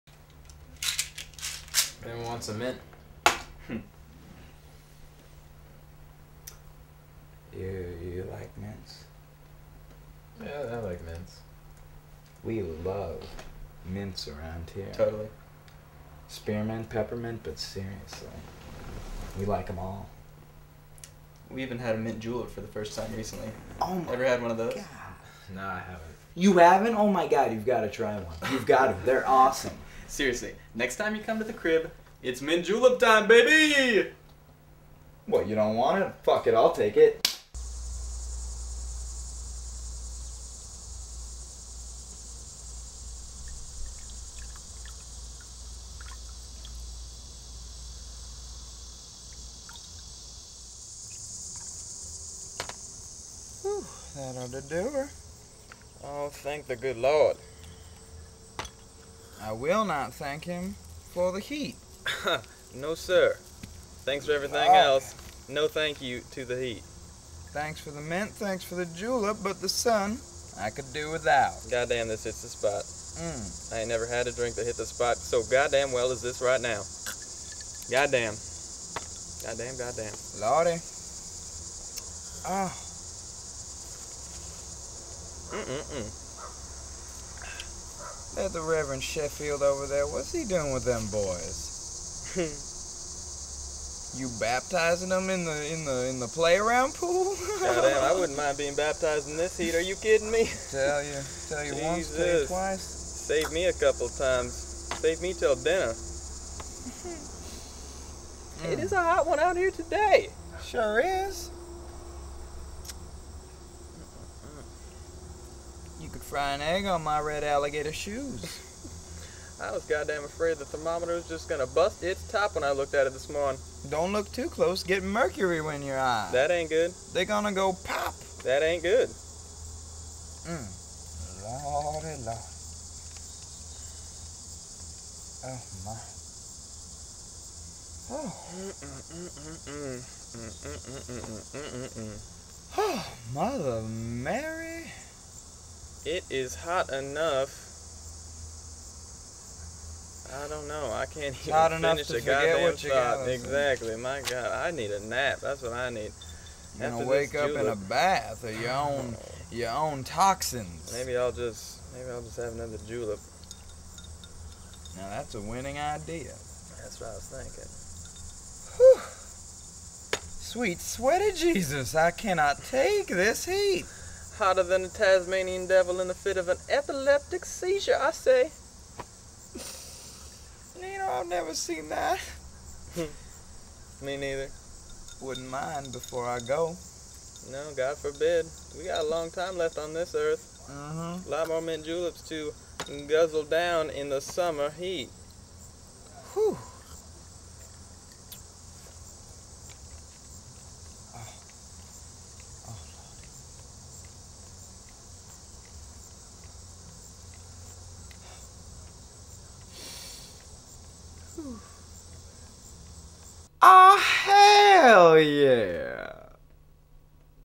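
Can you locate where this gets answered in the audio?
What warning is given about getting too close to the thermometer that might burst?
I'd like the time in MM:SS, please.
02:05.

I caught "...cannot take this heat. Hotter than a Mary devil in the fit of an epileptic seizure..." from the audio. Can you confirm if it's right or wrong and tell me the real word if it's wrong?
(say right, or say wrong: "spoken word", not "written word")
wrong: "Tasmanian", not "Mary".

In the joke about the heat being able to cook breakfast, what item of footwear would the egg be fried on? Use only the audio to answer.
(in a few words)
red alligator shoes.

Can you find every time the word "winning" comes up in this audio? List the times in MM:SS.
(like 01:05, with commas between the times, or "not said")
02:45.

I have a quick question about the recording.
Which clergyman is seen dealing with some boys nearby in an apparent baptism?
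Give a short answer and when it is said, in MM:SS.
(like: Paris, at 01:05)
Reverend Sheffield, at 01:28.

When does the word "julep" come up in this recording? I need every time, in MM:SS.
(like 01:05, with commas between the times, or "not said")
00:22, 00:32, 01:08, 02:37, 02:42, 03:11.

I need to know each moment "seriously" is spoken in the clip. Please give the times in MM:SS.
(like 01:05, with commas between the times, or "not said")
00:17, 00:30.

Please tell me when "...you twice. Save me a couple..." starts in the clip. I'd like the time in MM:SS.
01:42.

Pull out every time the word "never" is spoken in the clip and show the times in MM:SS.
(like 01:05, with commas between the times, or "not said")
01:13, 03:01.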